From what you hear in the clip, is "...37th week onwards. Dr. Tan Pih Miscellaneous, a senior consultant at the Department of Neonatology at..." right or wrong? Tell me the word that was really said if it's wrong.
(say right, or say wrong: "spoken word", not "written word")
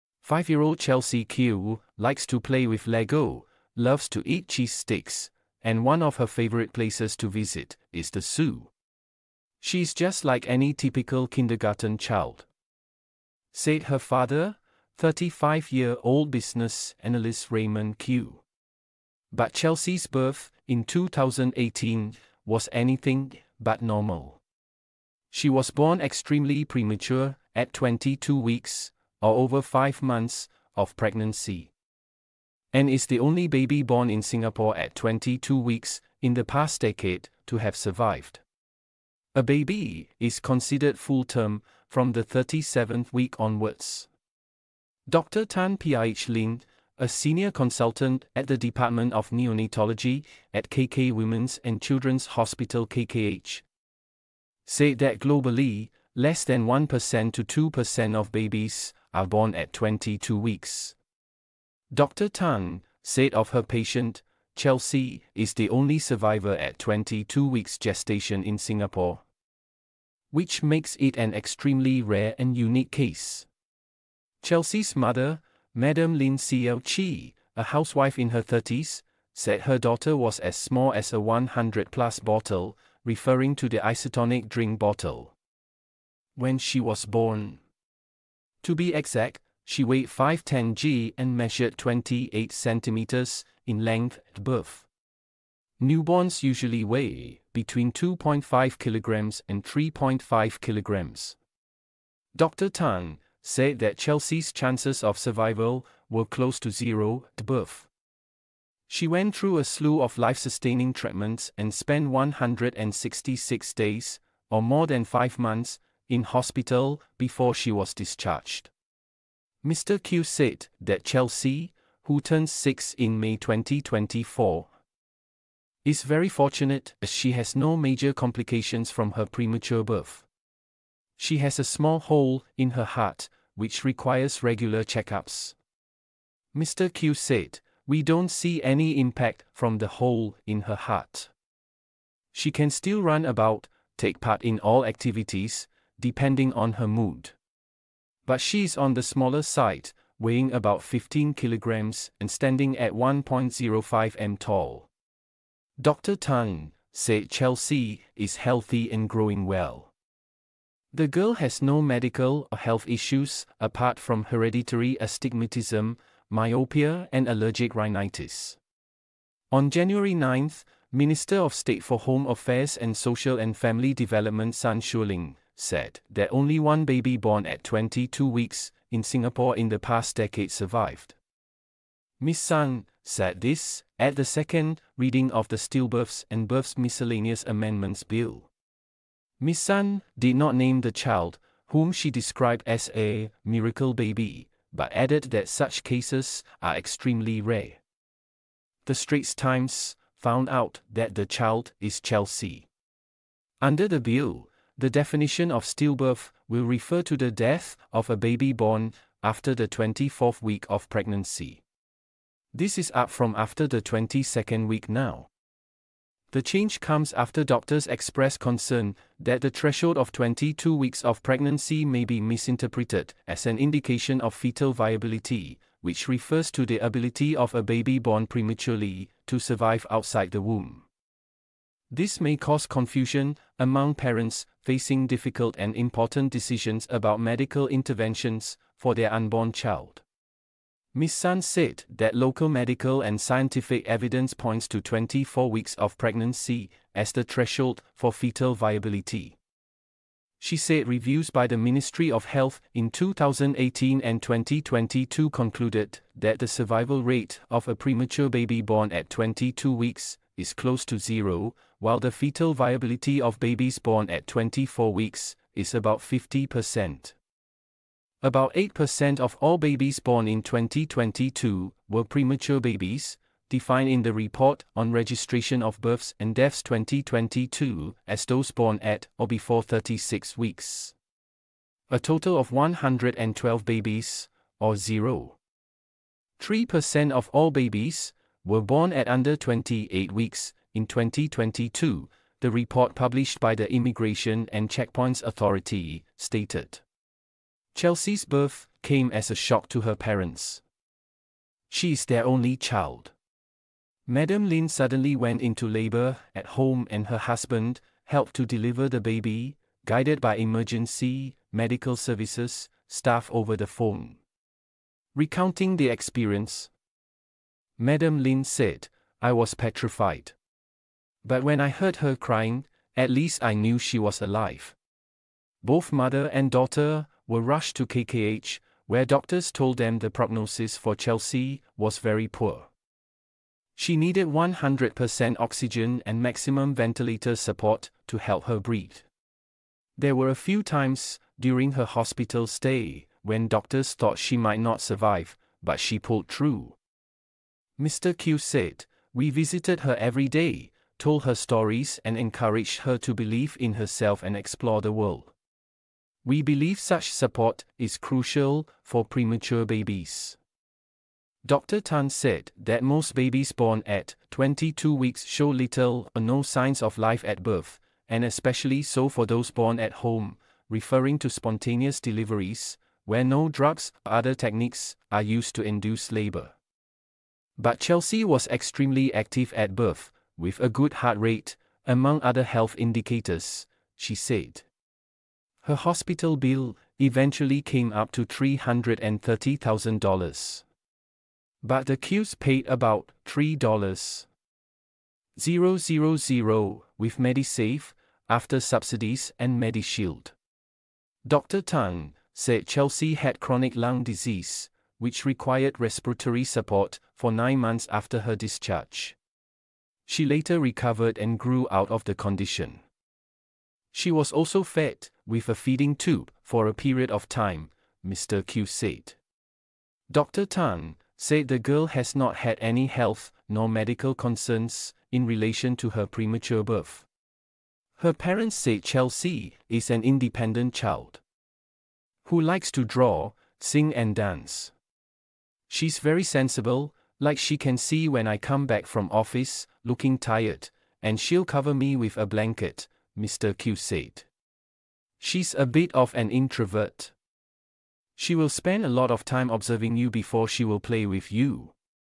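wrong: "Lin", not "Miscellaneous".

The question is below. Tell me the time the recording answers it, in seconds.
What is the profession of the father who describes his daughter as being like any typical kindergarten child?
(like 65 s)
16 s.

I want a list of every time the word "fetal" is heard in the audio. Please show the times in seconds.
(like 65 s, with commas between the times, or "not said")
224 s, 248 s, 262 s.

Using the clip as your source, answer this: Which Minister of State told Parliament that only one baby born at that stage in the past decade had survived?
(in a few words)
Sun Xueling.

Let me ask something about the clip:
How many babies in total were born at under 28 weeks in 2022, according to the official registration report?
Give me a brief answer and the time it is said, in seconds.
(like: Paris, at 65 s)
112, at 282 s.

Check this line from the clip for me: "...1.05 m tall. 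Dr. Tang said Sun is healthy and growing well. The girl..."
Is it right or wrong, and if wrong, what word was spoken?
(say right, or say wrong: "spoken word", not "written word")
wrong: "Chelsea", not "Sun".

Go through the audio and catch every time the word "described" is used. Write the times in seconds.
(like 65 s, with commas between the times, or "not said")
192 s.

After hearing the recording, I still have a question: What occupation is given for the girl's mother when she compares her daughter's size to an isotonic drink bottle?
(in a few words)
Housewife.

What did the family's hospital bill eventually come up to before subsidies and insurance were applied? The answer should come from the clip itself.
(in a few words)
$330,000.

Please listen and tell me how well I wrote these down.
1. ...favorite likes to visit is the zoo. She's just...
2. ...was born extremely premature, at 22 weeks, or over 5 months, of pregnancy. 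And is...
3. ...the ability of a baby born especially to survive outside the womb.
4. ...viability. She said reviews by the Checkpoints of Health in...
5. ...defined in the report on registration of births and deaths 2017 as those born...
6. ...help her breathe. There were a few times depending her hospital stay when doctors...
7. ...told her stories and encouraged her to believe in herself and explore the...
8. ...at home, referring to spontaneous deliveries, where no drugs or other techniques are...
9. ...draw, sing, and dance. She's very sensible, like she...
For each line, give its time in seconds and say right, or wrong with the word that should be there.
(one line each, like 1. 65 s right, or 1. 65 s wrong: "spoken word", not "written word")
1. 6 s wrong: "places", not "likes"
2. 25 s right
3. 226 s wrong: "prematurely", not "especially"
4. 248 s wrong: "Ministry", not "Checkpoints"
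5. 273 s wrong: "2022", not "2017"
6. 338 s wrong: "during", not "depending"
7. 351 s right
8. 369 s right
9. 432 s right.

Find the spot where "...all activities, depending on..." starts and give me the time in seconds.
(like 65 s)
144 s.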